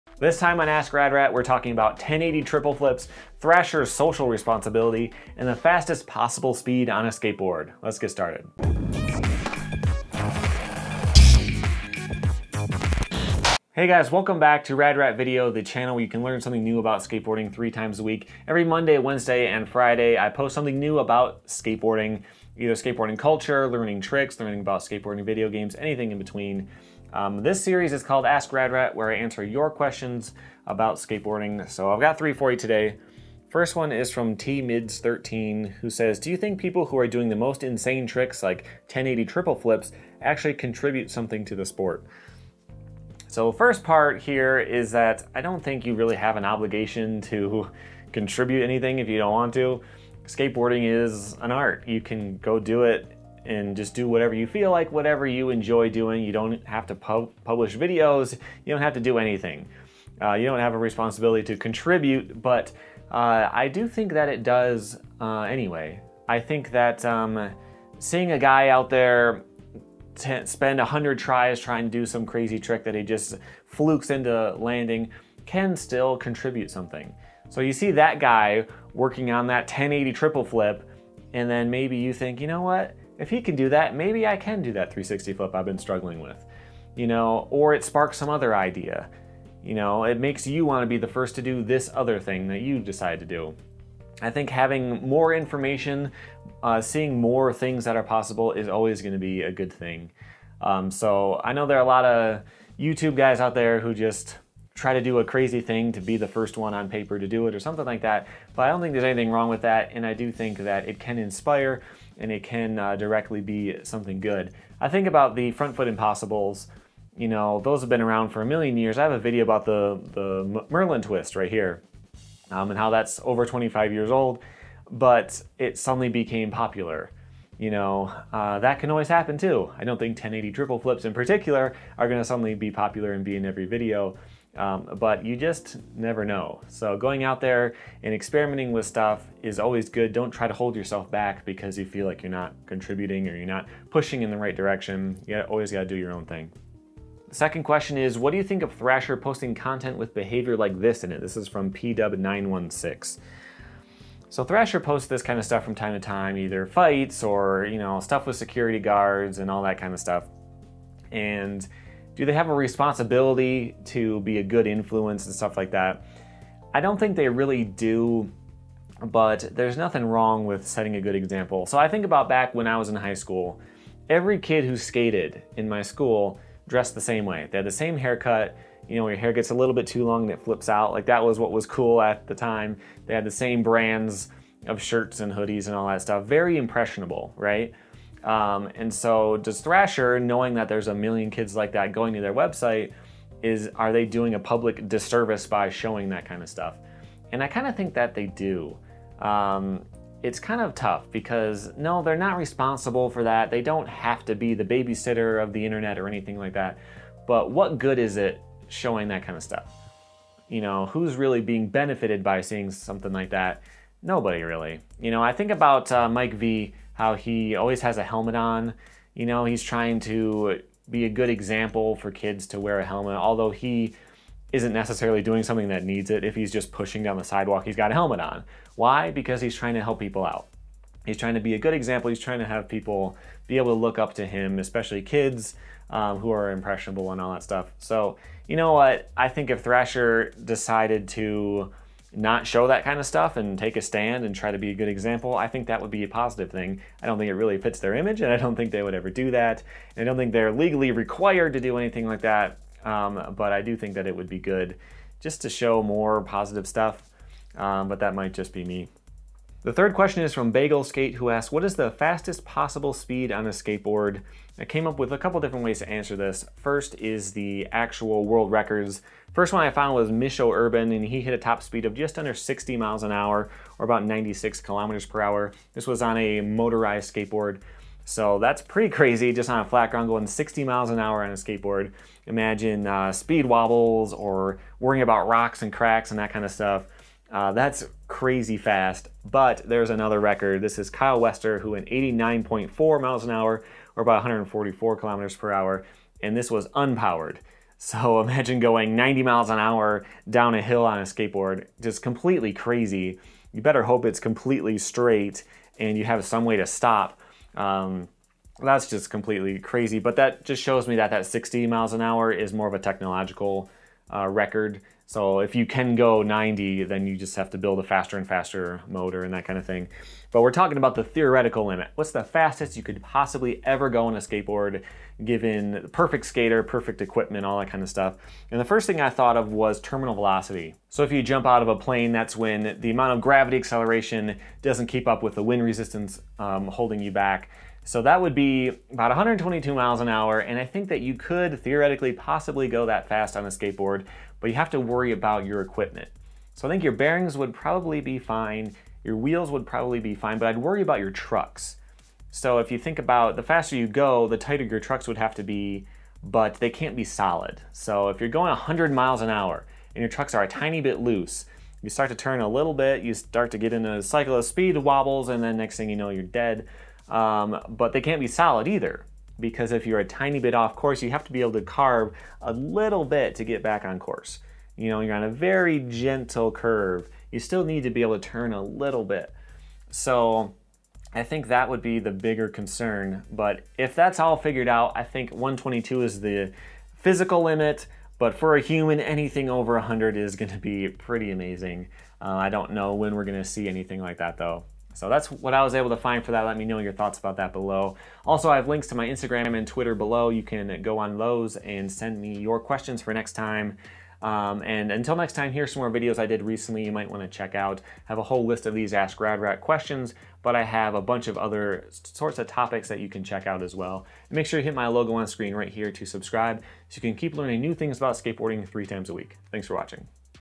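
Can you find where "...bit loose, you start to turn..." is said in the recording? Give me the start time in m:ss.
6:00.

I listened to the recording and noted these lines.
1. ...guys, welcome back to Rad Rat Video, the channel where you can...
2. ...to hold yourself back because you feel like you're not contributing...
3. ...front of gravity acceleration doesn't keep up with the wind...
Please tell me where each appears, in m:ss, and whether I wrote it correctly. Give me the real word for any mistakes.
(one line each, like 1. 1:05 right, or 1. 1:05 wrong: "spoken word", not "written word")
1. 0:13 right
2. 2:20 right
3. 5:32 wrong: "amount", not "front".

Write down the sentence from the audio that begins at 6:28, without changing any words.
But for a human, anything over 100 is going to be pretty amazing.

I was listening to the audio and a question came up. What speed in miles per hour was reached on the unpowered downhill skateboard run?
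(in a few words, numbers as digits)
89.4 miles an hour.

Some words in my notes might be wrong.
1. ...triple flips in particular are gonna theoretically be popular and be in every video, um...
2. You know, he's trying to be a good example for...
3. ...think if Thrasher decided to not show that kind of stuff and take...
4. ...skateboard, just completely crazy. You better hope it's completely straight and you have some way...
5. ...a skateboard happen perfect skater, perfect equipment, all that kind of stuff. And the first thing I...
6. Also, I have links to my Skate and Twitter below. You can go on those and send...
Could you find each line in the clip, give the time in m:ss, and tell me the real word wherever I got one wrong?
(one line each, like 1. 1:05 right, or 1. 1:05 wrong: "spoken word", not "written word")
1. 2:10 wrong: "suddenly", not "theoretically"
2. 3:39 right
3. 3:59 right
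4. 5:01 right
5. 5:24 wrong: "given", not "happen"
6. 6:38 wrong: "Instagram", not "Skate".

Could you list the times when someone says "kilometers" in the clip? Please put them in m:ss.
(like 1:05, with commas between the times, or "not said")
4:34, 4:54.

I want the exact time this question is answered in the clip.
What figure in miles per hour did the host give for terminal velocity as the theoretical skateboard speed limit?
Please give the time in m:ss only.
5:39.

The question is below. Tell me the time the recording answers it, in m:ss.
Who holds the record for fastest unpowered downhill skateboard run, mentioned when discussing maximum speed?
4:50.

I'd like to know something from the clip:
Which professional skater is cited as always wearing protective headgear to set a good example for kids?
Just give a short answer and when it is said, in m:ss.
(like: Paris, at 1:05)
Mike V, at 3:36.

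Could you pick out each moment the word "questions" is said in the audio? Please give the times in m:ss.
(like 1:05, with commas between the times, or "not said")
0:29, 2:27, 4:19, 6:42, 6:49.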